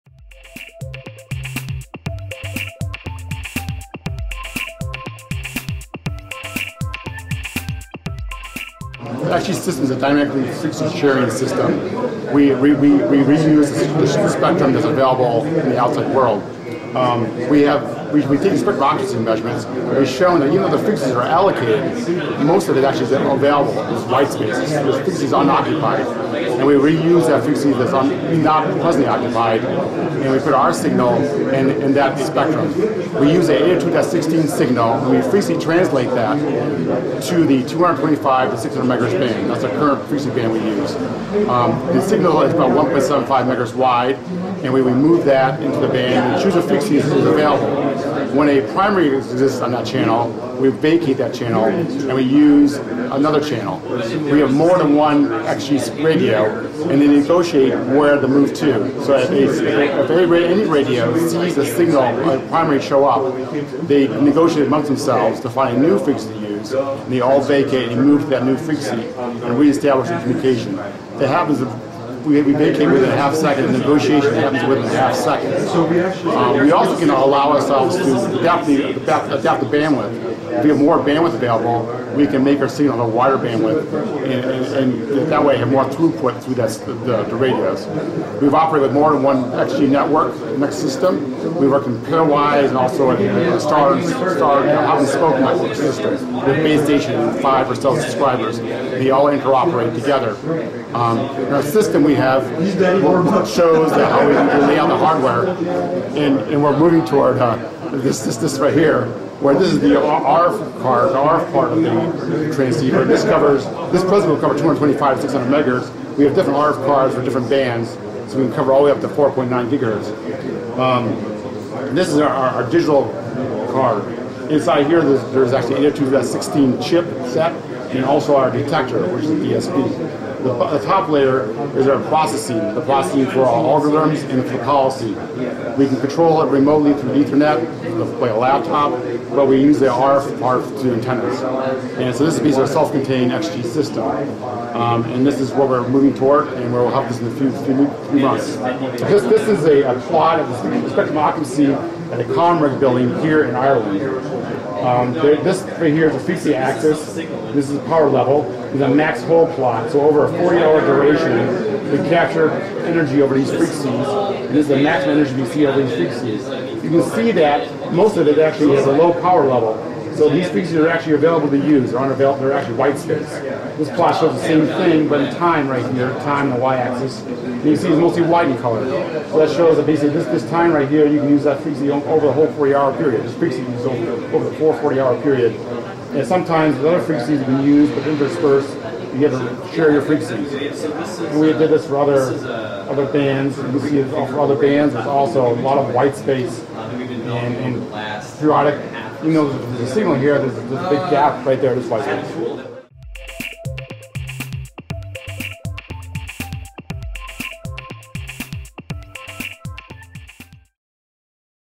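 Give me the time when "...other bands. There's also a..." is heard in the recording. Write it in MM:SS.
03:14.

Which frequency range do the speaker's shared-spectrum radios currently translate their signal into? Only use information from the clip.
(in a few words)
225 to 600 MHz.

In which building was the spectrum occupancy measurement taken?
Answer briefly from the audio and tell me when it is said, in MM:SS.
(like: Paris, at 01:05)
ComReg building, at 02:32.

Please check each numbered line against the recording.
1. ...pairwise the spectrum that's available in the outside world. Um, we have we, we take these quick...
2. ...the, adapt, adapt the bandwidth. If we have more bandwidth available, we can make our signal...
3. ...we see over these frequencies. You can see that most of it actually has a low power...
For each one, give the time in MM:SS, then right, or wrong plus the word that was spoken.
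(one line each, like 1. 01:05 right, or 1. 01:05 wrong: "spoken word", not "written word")
1. 00:13 wrong: "reuse", not "pairwise"
2. 01:18 right
3. 02:45 right.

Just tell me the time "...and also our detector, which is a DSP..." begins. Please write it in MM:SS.
02:07.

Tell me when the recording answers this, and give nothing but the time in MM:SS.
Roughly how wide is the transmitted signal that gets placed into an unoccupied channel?
00:42.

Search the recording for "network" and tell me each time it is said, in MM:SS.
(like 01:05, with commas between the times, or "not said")
01:29, 01:35.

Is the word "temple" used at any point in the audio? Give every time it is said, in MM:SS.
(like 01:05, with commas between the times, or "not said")
not said.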